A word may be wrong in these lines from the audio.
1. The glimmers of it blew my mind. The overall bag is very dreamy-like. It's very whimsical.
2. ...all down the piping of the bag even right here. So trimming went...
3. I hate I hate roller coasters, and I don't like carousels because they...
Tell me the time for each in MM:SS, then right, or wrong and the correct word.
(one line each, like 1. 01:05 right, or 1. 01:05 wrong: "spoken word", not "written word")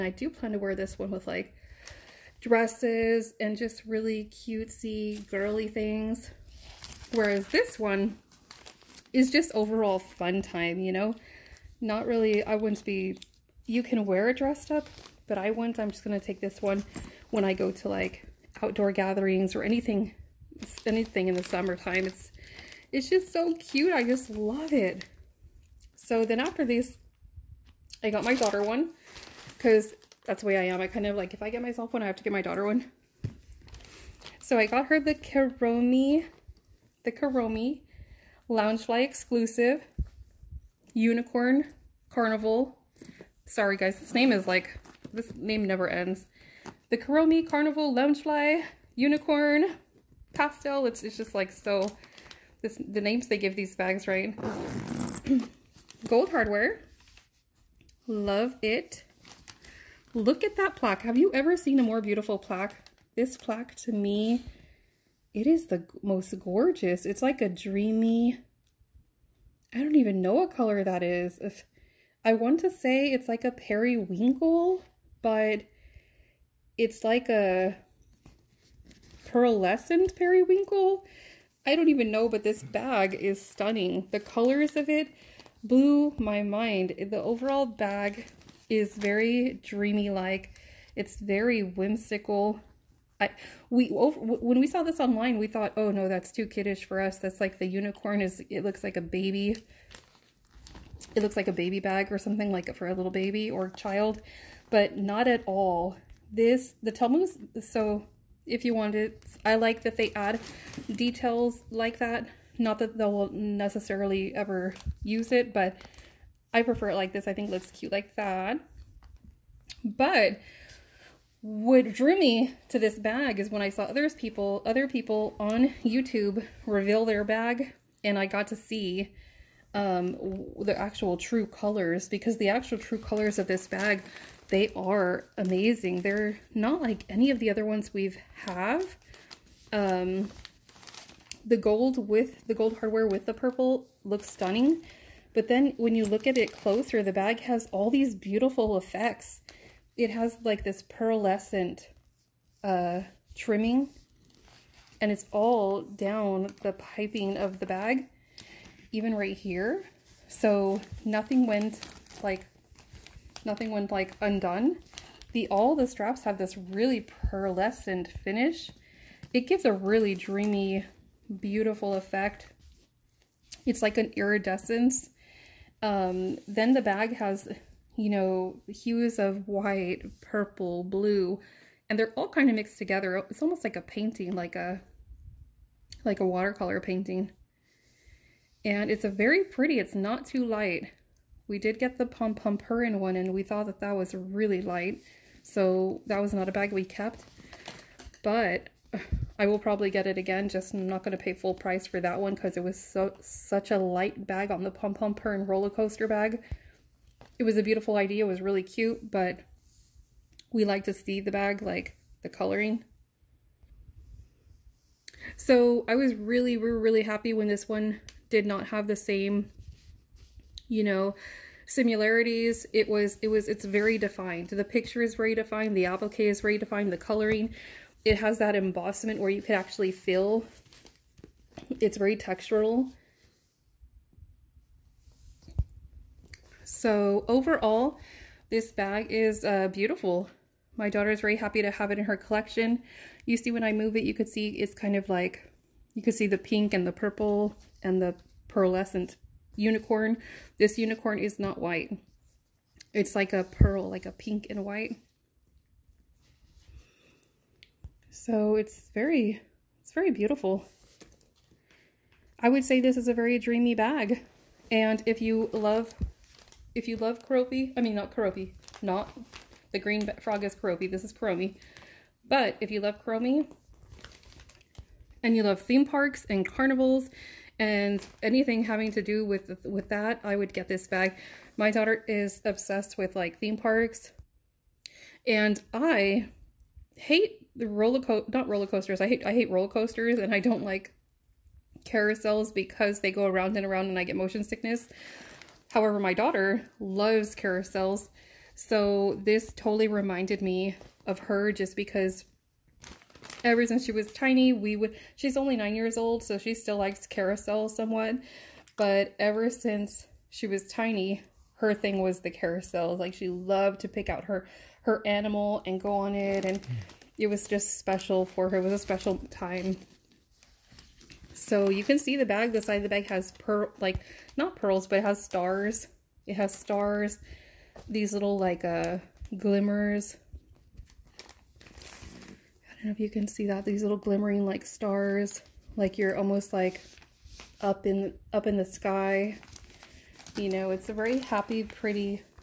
1. 01:24 wrong: "colors", not "glimmers"
2. 02:35 wrong: "nothing", not "trimming"
3. 04:48 right.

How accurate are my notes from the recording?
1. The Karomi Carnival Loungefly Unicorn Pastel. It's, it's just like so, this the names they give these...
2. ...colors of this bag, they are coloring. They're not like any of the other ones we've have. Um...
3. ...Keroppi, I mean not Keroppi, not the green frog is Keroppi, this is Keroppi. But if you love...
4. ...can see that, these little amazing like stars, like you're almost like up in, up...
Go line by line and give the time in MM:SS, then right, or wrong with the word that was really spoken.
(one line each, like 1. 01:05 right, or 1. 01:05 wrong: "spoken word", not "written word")
1. 00:46 right
2. 02:12 wrong: "amazing", not "coloring"
3. 04:27 wrong: "Kuromi", not "Keroppi"
4. 05:33 wrong: "glimmering", not "amazing".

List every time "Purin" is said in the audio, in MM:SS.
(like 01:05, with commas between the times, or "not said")
03:12, 03:25.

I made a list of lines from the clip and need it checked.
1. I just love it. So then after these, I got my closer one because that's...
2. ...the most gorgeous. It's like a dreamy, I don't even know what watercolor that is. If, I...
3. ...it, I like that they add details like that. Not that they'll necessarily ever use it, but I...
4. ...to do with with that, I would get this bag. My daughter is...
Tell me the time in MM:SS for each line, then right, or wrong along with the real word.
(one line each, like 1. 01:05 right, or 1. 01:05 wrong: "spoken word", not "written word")
1. 00:23 wrong: "daughter", not "closer"
2. 01:05 wrong: "color", not "watercolor"
3. 01:48 right
4. 04:38 right.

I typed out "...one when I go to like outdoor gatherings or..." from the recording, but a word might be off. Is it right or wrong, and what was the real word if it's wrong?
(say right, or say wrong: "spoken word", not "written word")
right.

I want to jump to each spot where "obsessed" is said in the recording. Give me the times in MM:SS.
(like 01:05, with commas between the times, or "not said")
04:42.